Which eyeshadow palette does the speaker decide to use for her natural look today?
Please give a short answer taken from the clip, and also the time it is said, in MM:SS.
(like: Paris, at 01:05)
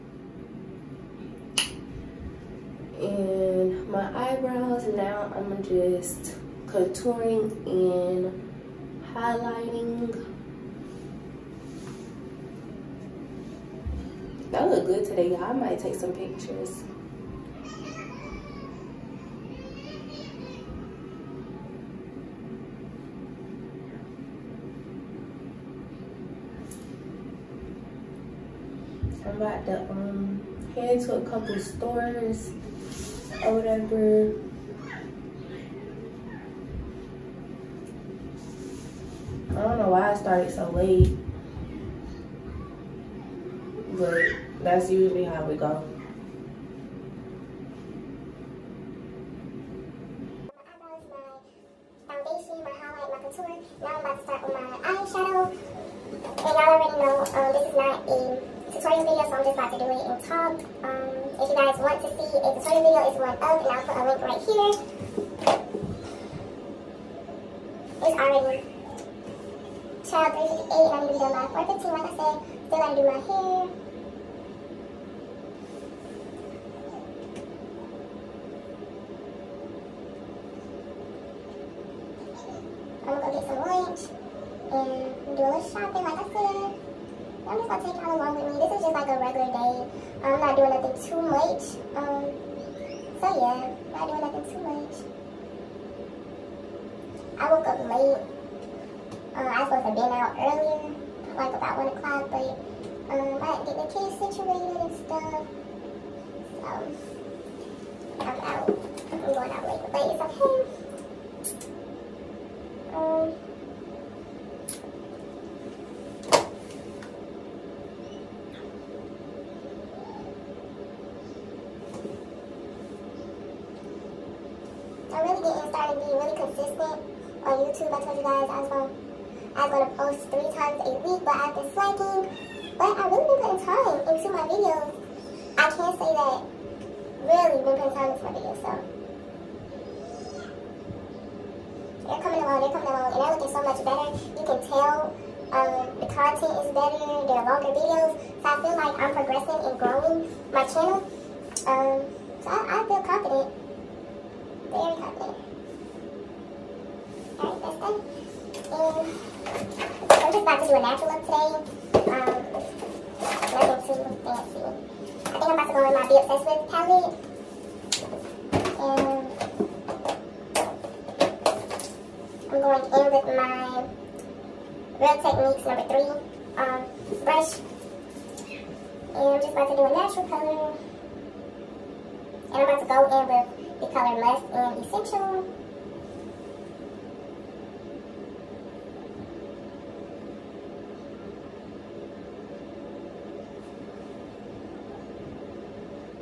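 Be Obsessed, at 02:46.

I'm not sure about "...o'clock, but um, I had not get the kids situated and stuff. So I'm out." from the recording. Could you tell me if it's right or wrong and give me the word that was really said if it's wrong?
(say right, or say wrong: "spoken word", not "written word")
right.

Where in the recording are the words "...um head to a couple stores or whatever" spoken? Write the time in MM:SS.
00:29.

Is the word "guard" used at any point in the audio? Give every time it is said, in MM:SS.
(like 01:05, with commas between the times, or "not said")
not said.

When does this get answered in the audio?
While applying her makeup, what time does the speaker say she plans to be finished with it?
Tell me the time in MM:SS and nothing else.
01:11.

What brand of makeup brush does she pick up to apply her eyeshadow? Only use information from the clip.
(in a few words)
Real Techniques.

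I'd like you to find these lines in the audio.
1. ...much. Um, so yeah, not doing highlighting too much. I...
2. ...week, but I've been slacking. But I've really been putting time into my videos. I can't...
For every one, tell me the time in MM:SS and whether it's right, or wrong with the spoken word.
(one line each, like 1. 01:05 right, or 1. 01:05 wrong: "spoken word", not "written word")
1. 01:31 wrong: "nothing", not "highlighting"
2. 02:11 right.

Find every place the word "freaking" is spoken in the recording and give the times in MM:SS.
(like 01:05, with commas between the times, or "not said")
not said.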